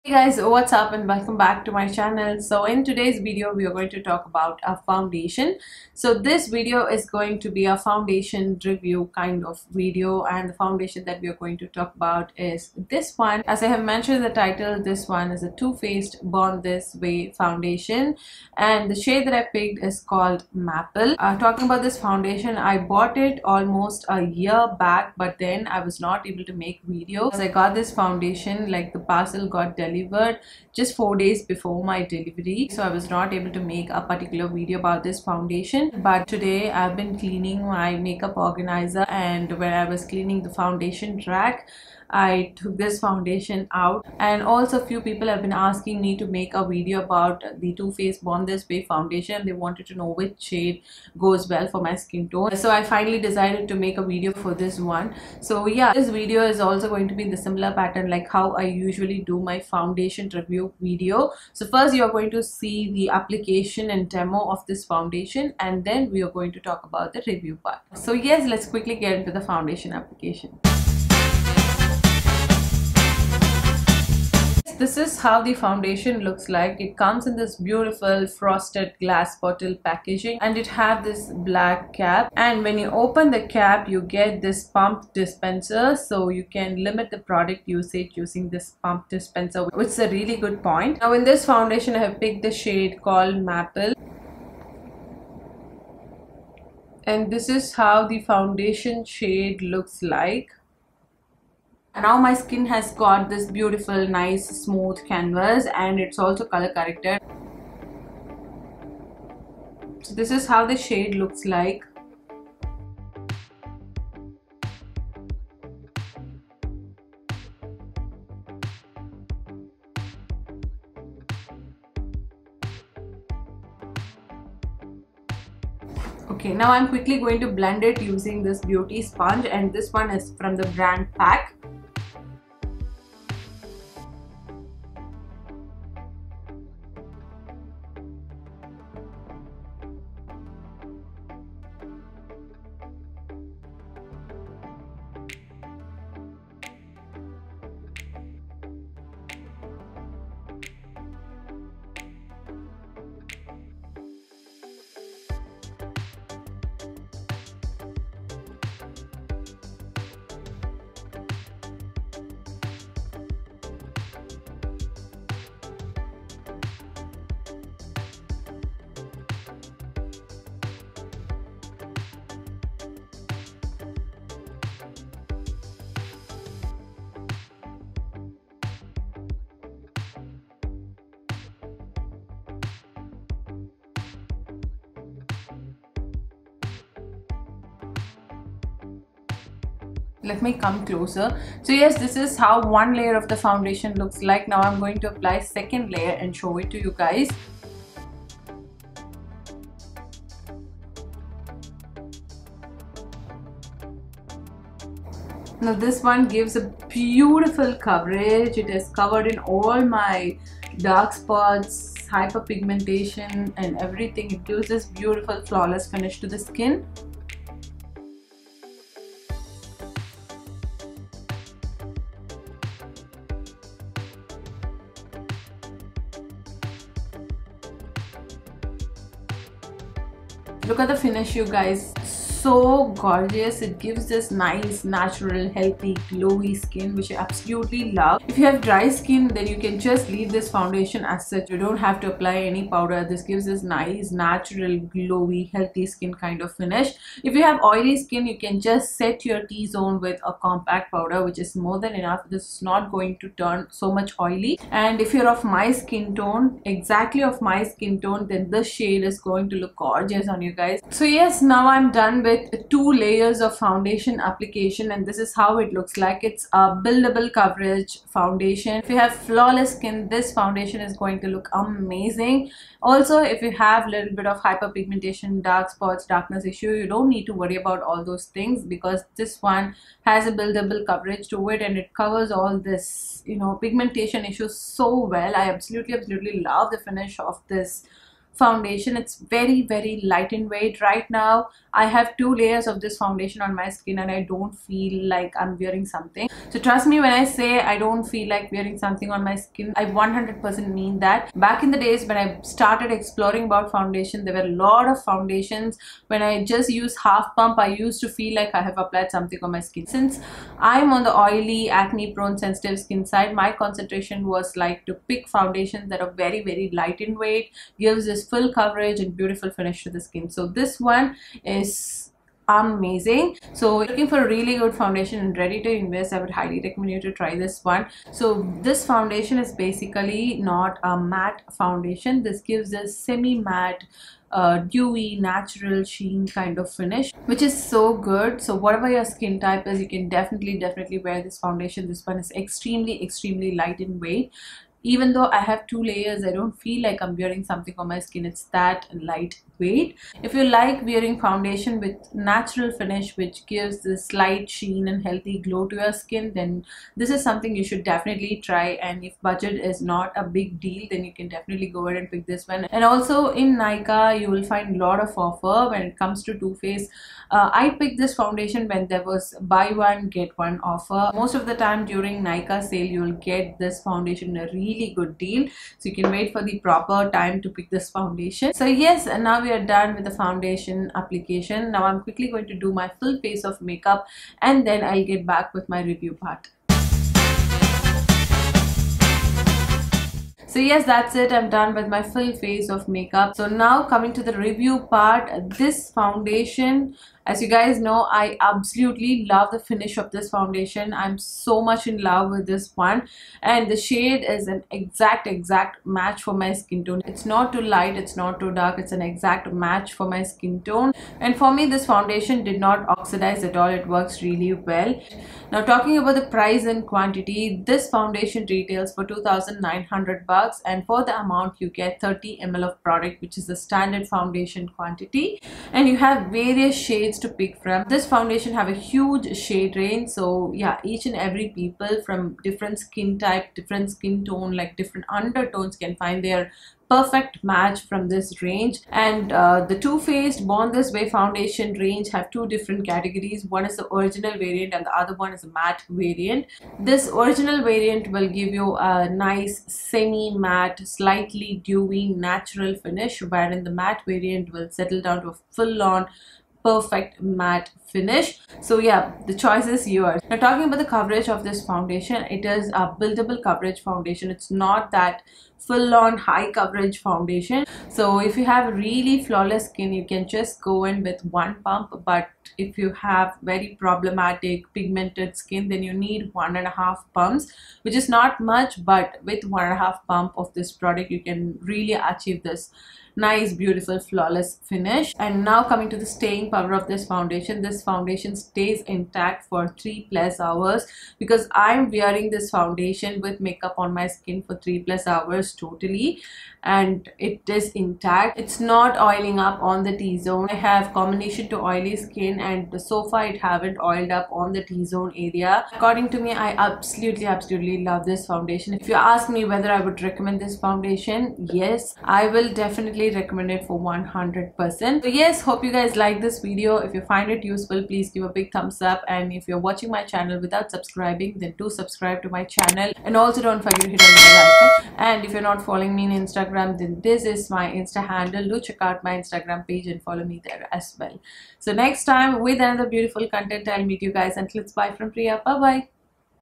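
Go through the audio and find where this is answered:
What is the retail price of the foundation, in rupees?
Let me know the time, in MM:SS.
06:59.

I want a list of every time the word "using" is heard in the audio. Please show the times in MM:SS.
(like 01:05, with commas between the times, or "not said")
01:28, 02:08.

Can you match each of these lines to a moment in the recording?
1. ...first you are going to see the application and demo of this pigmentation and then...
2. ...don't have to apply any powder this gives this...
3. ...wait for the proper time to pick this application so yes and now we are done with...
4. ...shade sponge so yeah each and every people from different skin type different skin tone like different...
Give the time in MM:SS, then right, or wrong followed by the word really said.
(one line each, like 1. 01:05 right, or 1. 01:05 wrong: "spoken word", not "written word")
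1. 01:01 wrong: "foundation", not "pigmentation"
2. 04:01 right
3. 06:16 wrong: "foundation", not "application"
4. 07:09 wrong: "range", not "sponge".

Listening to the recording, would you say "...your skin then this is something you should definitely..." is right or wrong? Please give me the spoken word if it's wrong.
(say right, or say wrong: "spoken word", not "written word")
right.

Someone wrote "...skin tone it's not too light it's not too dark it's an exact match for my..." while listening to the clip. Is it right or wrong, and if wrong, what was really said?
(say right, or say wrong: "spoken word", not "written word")
right.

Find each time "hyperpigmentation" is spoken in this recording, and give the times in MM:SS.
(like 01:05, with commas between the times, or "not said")
03:32, 04:34.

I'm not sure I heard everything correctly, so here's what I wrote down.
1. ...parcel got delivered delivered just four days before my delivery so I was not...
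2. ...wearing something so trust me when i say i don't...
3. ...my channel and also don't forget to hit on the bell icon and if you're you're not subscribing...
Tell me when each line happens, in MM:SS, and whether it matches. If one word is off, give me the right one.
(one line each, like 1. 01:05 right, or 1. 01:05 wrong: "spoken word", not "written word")
1. 00:28 right
2. 04:55 right
3. 08:42 wrong: "following", not "subscribing".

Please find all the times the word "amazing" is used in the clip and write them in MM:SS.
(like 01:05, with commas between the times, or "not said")
04:31, 05:22.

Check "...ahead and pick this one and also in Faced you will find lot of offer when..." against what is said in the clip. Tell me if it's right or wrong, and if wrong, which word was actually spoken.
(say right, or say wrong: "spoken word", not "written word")
wrong: "Nykaa", not "Faced".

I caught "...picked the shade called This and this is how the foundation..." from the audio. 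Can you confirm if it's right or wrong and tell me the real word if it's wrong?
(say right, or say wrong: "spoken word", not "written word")
wrong: "Maple", not "This".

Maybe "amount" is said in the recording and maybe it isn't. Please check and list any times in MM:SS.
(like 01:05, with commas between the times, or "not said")
07:01.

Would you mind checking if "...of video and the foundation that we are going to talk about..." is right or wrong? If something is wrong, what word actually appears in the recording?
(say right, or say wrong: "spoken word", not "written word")
right.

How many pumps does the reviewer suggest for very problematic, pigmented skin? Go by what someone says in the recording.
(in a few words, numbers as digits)
1.5.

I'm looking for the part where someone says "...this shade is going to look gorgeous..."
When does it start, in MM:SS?
04:18.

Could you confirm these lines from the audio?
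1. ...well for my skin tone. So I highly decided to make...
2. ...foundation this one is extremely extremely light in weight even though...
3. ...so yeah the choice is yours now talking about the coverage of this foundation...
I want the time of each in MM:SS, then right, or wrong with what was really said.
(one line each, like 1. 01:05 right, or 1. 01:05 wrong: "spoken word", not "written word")
1. 00:51 wrong: "finally", not "highly"
2. 05:41 right
3. 07:38 right.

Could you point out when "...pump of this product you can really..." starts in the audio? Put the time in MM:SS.
08:00.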